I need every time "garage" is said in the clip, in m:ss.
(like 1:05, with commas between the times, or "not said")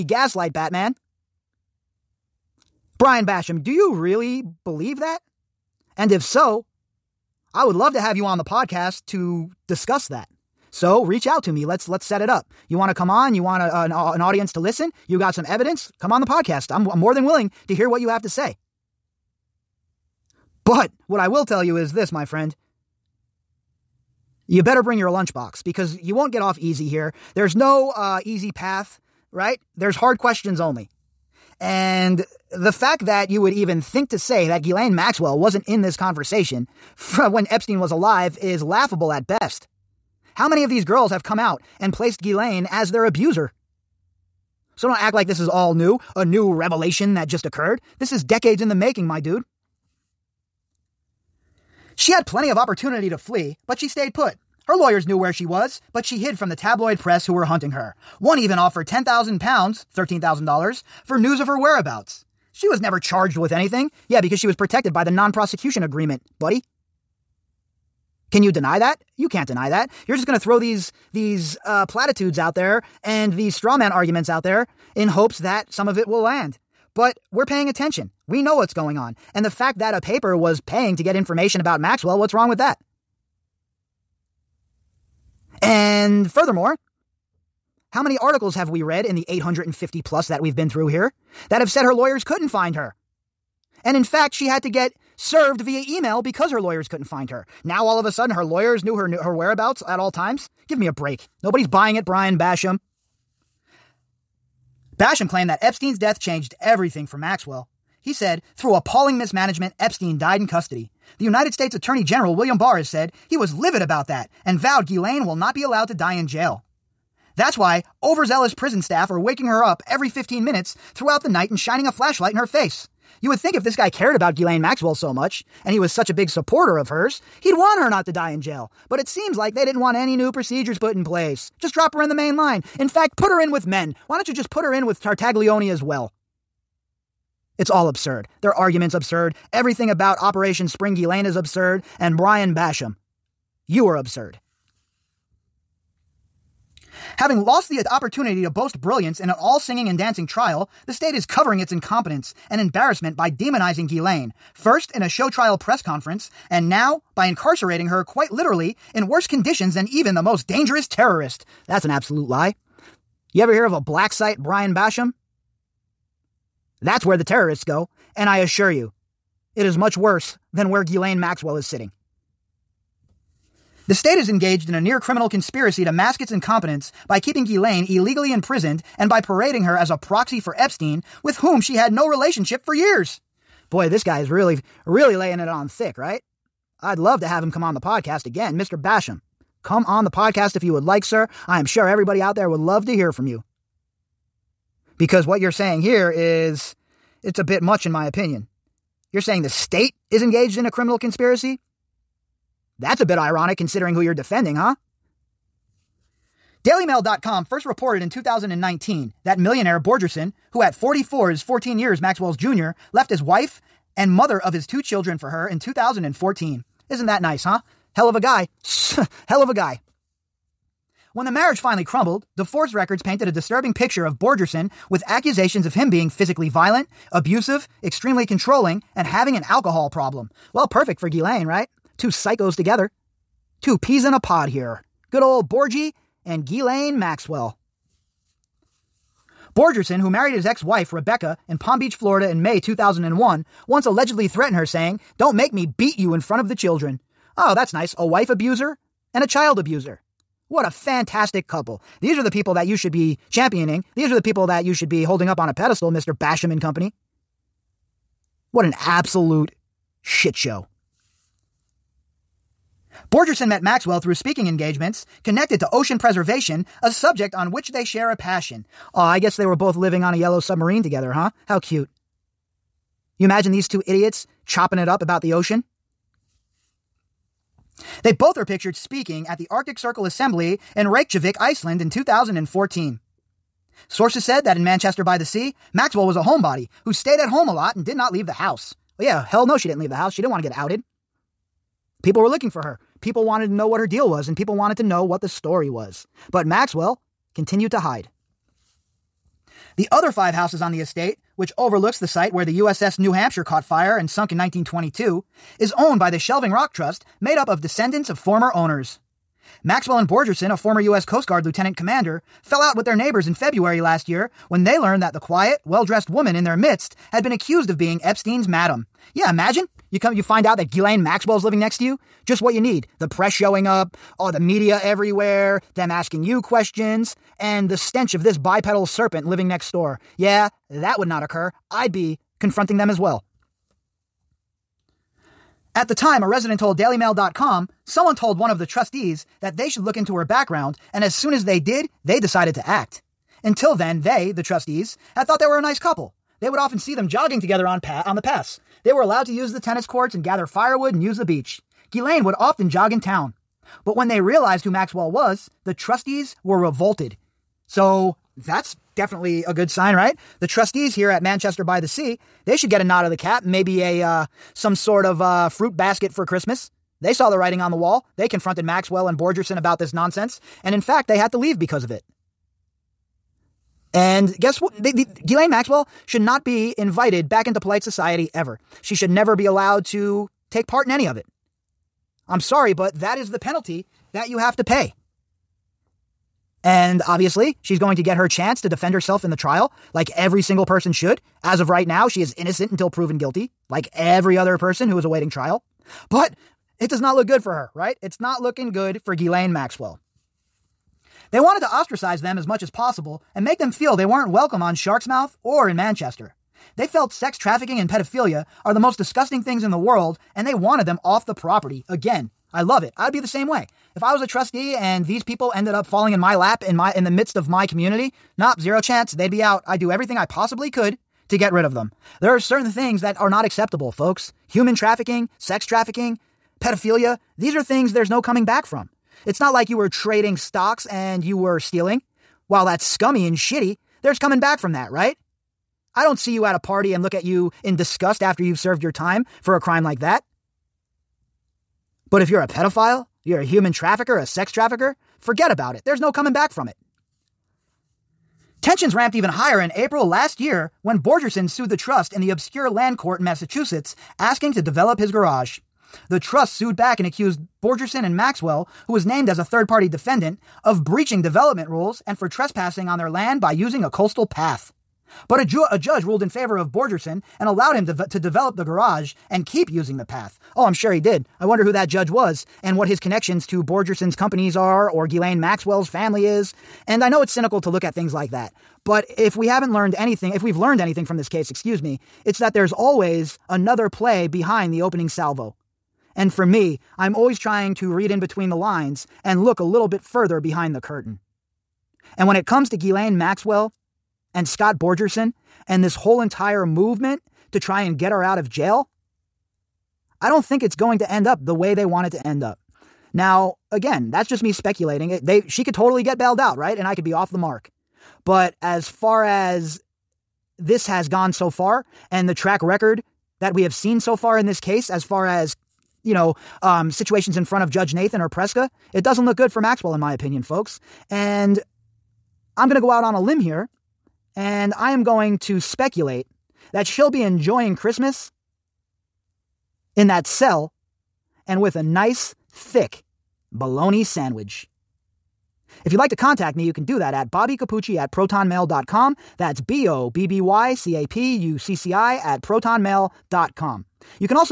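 7:35, 7:48.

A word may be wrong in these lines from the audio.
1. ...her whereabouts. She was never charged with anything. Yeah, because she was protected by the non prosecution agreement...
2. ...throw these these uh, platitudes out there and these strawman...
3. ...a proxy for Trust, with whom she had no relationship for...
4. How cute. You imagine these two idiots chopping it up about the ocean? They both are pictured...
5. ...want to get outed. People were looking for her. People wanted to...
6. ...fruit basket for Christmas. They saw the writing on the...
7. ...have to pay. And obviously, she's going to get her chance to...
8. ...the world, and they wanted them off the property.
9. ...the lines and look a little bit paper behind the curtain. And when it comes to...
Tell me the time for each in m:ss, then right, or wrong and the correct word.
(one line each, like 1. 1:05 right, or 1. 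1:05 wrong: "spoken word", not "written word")
1. 1:01 right
2. 1:10 right
3. 2:59 wrong: "Epstein", not "Trust"
4. 4:31 right
5. 4:50 right
6. 6:05 right
7. 6:24 right
8. 6:49 right
9. 8:08 wrong: "further", not "paper".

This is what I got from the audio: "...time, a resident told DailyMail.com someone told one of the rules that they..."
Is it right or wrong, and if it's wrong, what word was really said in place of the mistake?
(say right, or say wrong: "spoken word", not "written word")
wrong: "trustees", not "rules".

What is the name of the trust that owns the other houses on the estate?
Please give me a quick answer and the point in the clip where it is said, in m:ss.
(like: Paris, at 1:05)
Shelving Rock Trust, at 5:06.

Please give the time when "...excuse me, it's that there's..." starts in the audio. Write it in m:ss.
8:01.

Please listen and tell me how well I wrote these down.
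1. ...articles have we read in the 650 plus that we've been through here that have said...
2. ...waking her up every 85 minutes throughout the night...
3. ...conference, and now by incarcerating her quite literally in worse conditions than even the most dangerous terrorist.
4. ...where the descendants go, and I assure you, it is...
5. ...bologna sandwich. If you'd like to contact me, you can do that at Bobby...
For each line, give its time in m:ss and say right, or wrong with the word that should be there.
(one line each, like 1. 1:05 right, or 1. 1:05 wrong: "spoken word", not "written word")
1. 1:28 wrong: "850", not "650"
2. 1:59 wrong: "15", not "85"
3. 2:35 right
4. 2:47 wrong: "terrorists", not "descendants"
5. 8:53 right.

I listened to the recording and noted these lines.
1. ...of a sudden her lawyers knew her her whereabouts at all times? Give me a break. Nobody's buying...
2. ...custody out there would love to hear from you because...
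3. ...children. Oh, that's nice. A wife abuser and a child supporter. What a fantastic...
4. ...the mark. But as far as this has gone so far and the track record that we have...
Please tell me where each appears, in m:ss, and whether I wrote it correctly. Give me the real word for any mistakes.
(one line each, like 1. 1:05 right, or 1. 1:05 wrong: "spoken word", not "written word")
1. 1:37 right
2. 3:11 wrong: "everybody", not "custody"
3. 4:06 wrong: "abuser", not "supporter"
4. 8:27 right.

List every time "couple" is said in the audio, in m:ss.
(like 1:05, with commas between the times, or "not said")
4:11, 5:45.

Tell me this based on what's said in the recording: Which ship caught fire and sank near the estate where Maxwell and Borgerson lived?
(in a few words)
USS New Hampshire.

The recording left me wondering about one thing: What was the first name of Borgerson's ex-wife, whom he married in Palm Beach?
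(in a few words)
Rebecca.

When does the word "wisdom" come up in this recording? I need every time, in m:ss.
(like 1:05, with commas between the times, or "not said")
not said.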